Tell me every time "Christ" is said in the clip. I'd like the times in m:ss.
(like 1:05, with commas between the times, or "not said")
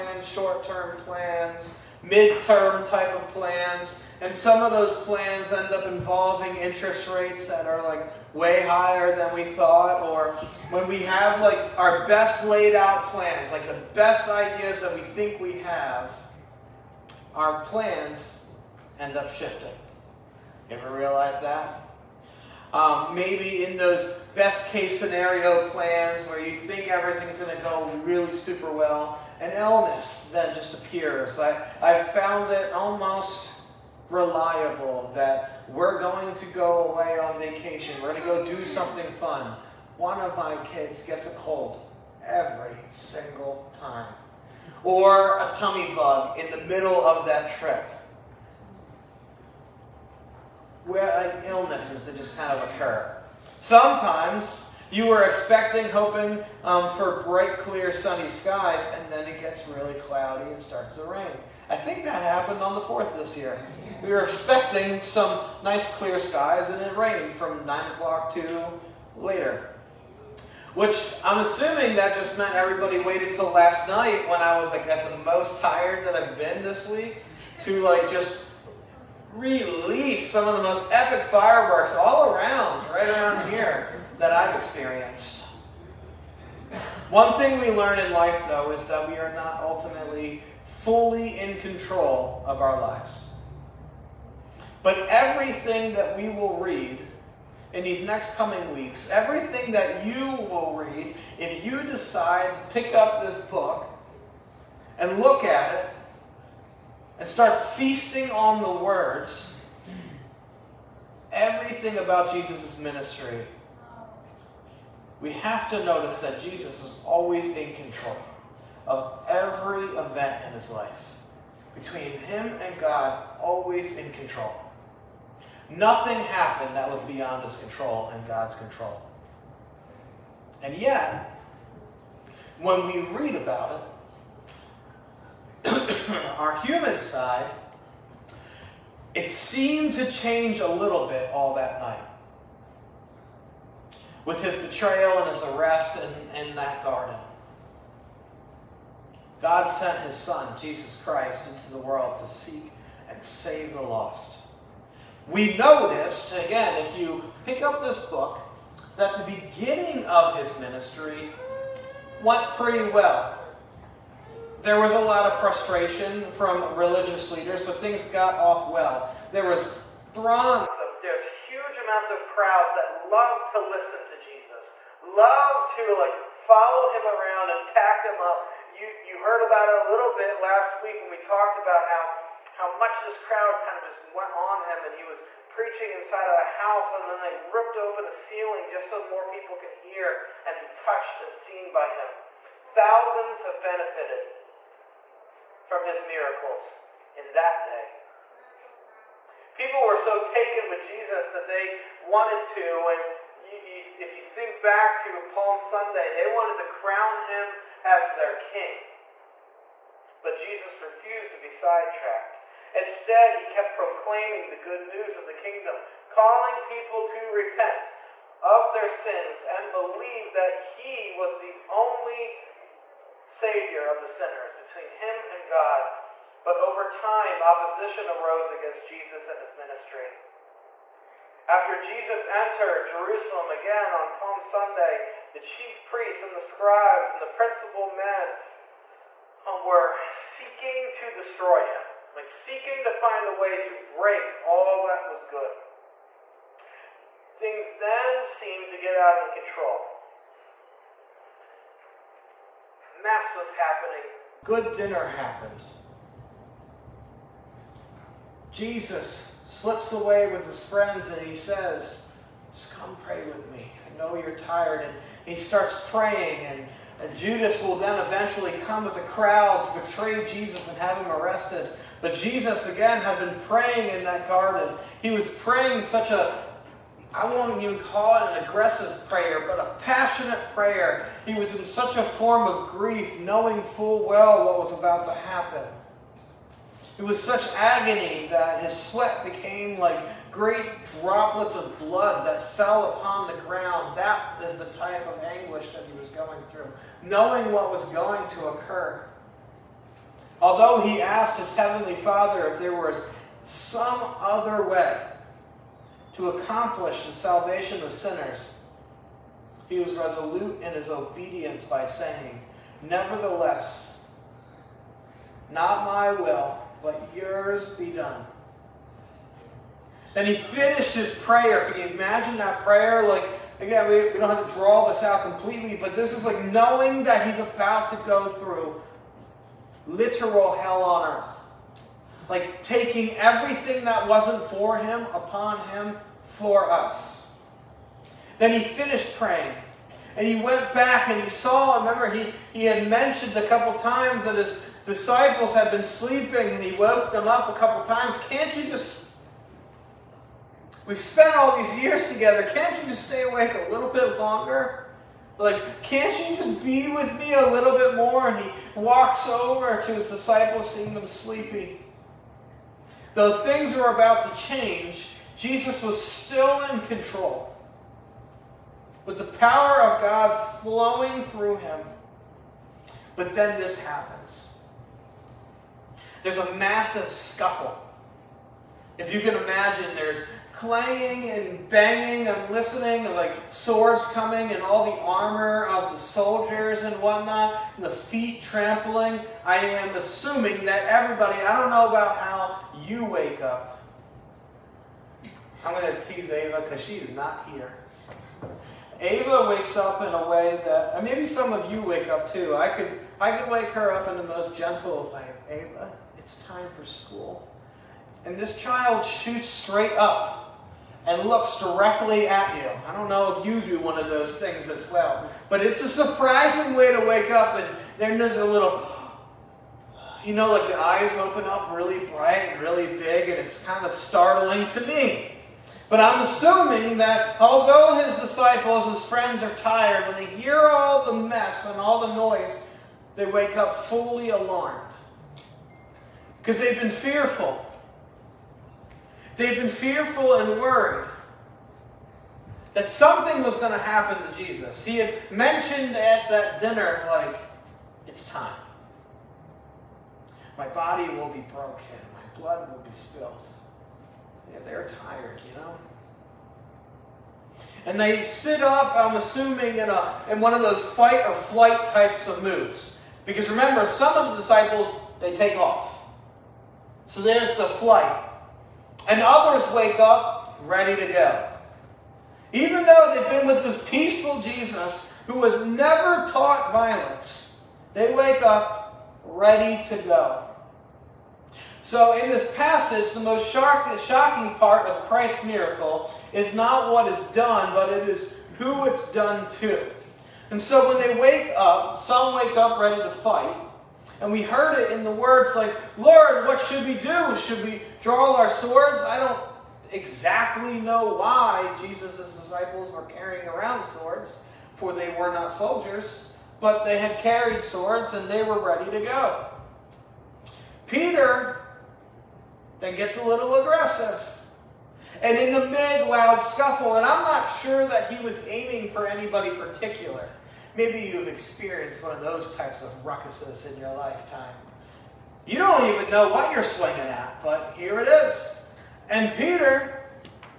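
2:31, 8:05.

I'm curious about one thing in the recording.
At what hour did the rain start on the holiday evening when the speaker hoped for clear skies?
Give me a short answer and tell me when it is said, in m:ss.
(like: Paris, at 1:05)
9 o'clock, at 1:07.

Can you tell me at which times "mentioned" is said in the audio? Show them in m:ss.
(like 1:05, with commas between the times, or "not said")
5:42, 7:25.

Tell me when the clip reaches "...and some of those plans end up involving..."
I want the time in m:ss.
0:04.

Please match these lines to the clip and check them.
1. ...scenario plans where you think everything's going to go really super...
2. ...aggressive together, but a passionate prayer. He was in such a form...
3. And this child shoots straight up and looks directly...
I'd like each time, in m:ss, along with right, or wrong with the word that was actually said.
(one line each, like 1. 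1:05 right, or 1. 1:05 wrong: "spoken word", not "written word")
1. 0:24 right
2. 4:38 wrong: "prayer", not "together"
3. 6:48 right.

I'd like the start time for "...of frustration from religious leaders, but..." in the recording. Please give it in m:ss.
2:45.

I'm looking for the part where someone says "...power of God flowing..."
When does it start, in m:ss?
6:09.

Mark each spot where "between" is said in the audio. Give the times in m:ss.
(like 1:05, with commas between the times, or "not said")
2:01, 3:44.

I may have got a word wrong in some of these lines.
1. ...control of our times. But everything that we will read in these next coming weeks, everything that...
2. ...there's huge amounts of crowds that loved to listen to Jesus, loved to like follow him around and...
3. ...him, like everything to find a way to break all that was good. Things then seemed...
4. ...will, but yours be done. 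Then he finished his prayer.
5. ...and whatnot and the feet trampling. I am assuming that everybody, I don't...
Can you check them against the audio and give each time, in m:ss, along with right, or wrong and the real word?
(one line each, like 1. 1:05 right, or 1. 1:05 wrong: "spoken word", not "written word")
1. 1:31 wrong: "lives", not "times"
2. 2:51 right
3. 4:01 wrong: "seeking", not "everything"
4. 5:16 right
5. 6:26 right.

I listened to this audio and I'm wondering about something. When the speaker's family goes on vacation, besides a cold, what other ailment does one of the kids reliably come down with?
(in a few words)
tummy bug.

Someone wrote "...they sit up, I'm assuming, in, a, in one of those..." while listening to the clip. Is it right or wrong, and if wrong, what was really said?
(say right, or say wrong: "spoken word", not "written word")
right.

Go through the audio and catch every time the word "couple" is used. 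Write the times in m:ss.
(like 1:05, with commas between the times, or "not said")
5:43, 5:47.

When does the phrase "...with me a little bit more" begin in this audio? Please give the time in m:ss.
5:56.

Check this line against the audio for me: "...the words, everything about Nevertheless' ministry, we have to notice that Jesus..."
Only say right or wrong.
wrong.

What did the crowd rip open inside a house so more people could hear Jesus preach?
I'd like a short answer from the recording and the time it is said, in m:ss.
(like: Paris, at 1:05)
ceiling, at 3:08.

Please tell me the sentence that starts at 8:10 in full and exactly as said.
And so when they wake up, some wake up ready to fight.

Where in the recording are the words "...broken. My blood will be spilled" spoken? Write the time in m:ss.
7:31.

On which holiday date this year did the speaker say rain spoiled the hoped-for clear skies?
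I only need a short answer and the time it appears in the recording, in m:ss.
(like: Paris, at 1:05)
the 4th, at 1:02.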